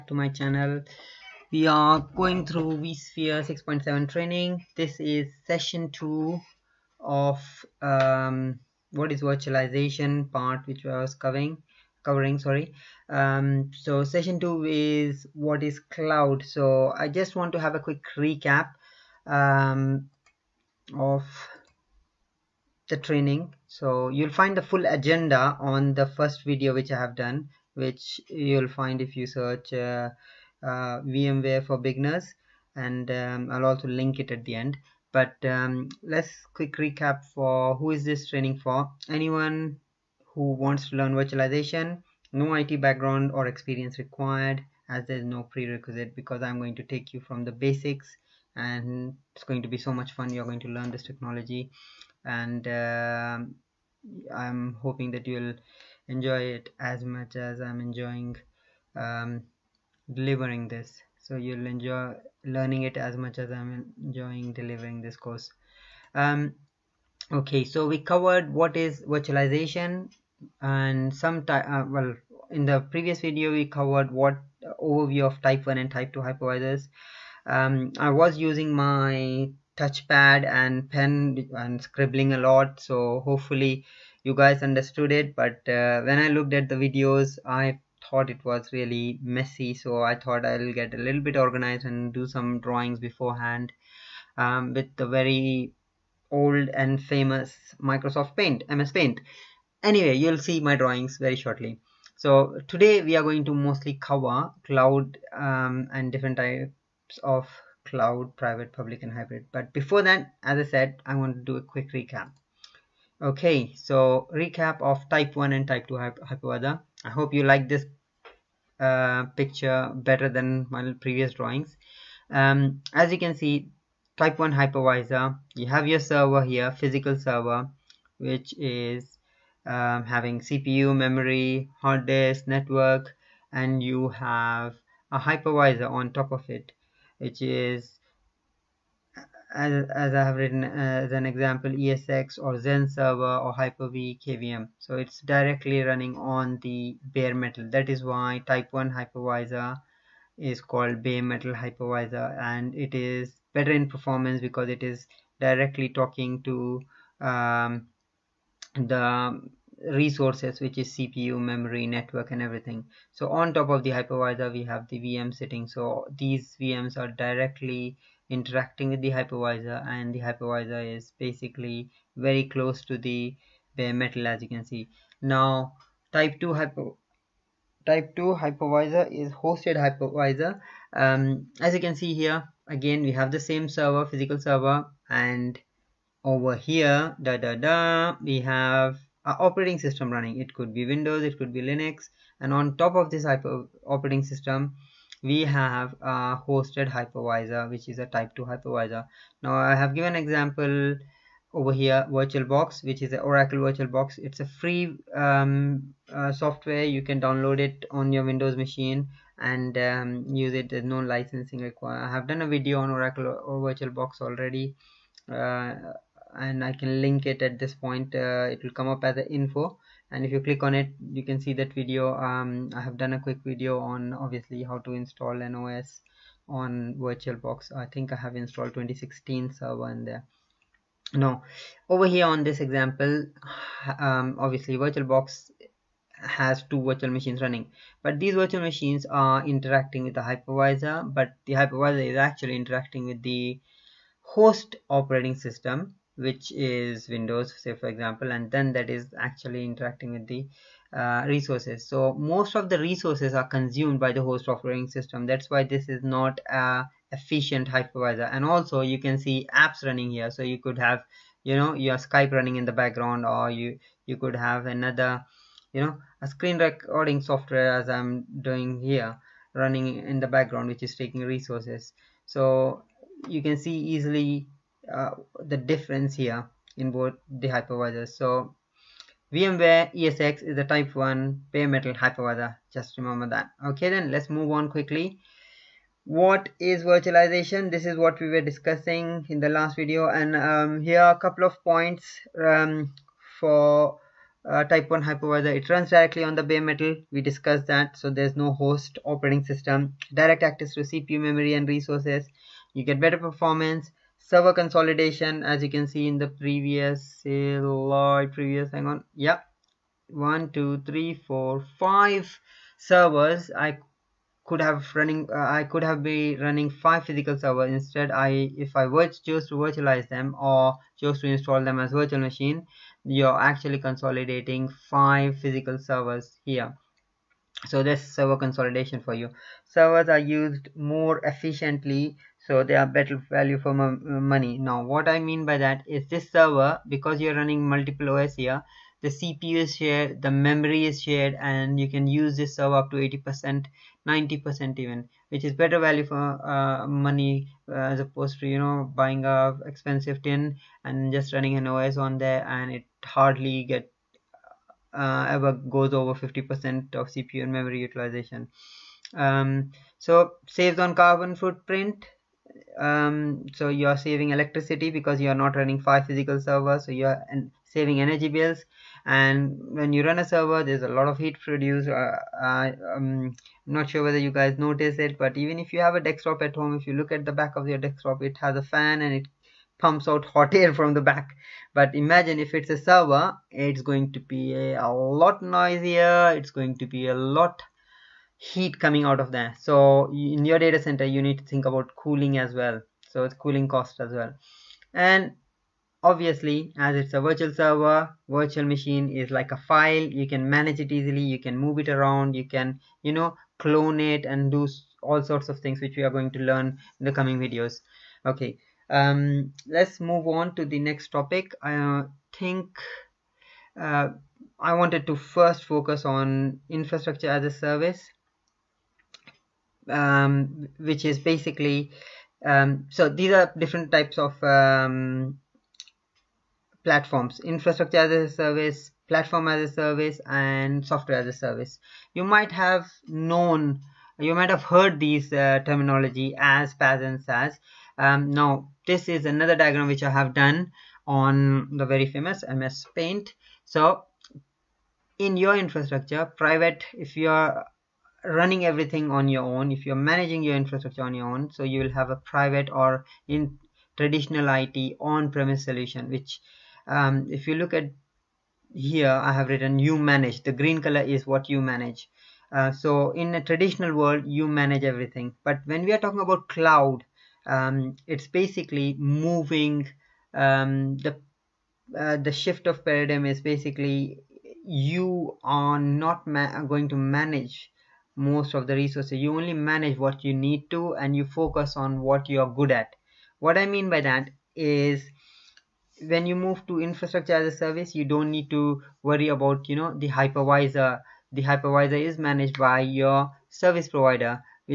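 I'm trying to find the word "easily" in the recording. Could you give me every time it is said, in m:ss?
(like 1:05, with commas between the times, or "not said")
4:33, 6:40.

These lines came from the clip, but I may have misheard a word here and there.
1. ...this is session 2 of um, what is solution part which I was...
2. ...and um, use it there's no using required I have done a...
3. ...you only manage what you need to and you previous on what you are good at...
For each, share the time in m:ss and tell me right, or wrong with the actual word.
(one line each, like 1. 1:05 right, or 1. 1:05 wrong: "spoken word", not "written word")
1. 0:04 wrong: "virtualization", not "solution"
2. 3:29 wrong: "licensing", not "using"
3. 7:59 wrong: "focus", not "previous".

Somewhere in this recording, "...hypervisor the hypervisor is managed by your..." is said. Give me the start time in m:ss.
8:10.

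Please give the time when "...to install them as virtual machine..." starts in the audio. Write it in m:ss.
5:21.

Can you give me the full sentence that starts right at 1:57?
I hope you like this uh, picture better than my previous drawings.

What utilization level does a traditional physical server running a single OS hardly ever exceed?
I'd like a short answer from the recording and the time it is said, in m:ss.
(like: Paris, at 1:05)
50 percent, at 5:56.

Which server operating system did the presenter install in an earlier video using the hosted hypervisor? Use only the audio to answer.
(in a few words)
2016 server.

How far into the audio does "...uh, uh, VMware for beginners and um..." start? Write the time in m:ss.
0:29.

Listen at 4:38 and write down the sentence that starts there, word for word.
So VMware ESX is the type 1 bare metal hypervisor.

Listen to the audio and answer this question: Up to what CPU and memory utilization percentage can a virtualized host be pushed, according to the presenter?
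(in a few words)
90 percent.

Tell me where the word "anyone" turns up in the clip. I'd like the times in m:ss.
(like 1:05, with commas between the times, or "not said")
0:39.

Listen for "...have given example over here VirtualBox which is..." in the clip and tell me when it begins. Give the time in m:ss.
3:19.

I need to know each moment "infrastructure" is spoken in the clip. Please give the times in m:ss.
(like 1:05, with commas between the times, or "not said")
6:56, 7:07, 7:25, 7:30, 8:06.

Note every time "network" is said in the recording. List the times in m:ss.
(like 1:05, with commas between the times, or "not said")
2:12, 2:41.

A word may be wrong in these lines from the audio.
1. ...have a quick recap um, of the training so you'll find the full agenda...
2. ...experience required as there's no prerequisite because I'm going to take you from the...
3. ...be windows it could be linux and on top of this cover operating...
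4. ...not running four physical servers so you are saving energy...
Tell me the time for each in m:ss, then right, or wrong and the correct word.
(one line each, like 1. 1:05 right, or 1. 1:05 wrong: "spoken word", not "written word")
1. 0:17 right
2. 0:43 right
3. 3:10 wrong: "hyper", not "cover"
4. 6:05 wrong: "five", not "four".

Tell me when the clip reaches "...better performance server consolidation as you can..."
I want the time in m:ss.
5:02.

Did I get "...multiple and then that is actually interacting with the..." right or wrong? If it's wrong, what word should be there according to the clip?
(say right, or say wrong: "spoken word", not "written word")
wrong: "example", not "multiple".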